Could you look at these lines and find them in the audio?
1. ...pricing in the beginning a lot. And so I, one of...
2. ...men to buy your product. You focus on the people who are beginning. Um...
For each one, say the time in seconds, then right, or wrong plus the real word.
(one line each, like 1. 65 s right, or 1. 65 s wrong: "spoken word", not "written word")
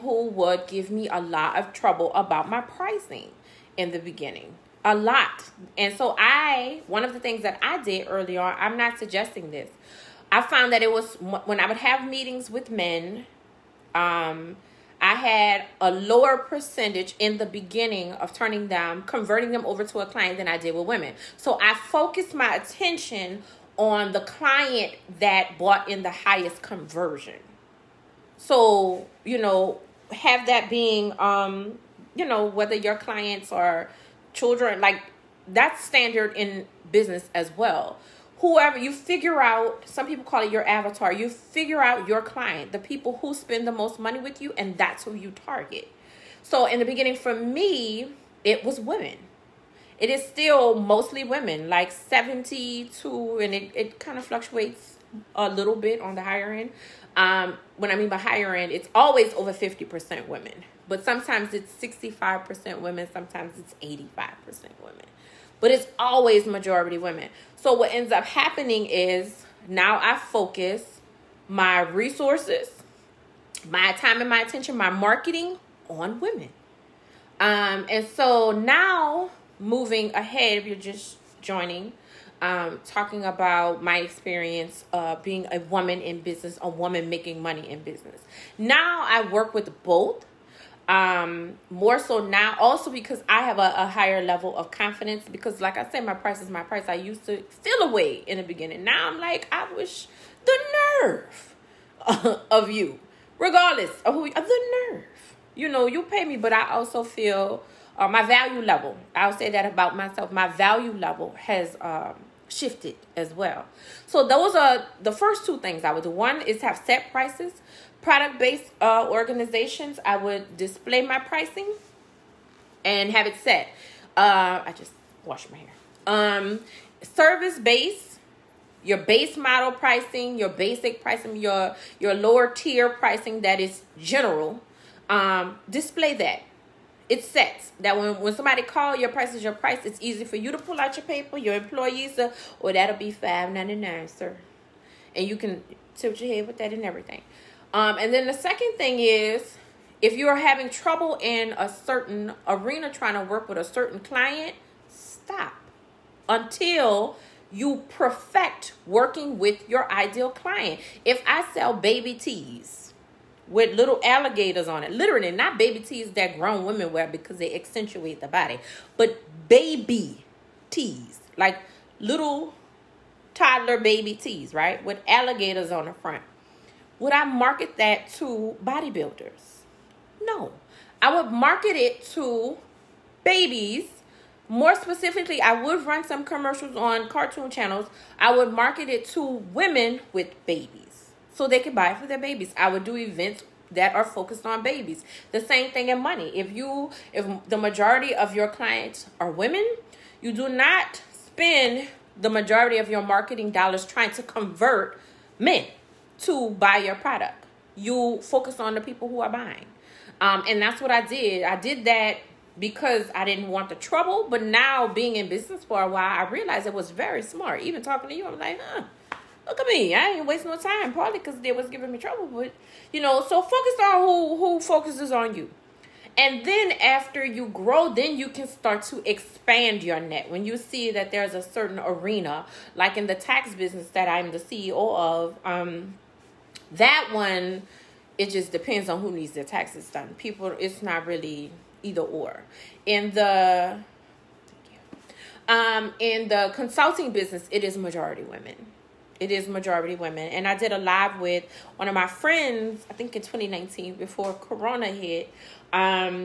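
1. 2 s right
2. 205 s wrong: "buying", not "beginning".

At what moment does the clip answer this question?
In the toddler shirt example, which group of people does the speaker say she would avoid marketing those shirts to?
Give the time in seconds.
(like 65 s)
178 s.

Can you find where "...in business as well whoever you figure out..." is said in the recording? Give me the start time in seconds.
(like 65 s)
36 s.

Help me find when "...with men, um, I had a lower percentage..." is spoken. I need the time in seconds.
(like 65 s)
12 s.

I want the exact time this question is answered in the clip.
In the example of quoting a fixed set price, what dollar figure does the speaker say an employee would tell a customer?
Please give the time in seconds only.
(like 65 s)
143 s.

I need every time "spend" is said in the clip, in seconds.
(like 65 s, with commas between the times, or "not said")
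43 s, 201 s.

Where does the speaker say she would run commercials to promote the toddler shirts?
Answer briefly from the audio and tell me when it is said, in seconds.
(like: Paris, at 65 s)
Cartoon channels, at 187 s.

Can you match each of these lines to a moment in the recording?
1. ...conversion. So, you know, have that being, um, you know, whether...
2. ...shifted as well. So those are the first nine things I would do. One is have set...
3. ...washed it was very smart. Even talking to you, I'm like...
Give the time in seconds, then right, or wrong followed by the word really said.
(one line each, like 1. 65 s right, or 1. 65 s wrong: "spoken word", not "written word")
1. 26 s right
2. 112 s wrong: "two", not "nine"
3. 216 s wrong: "realized", not "washed".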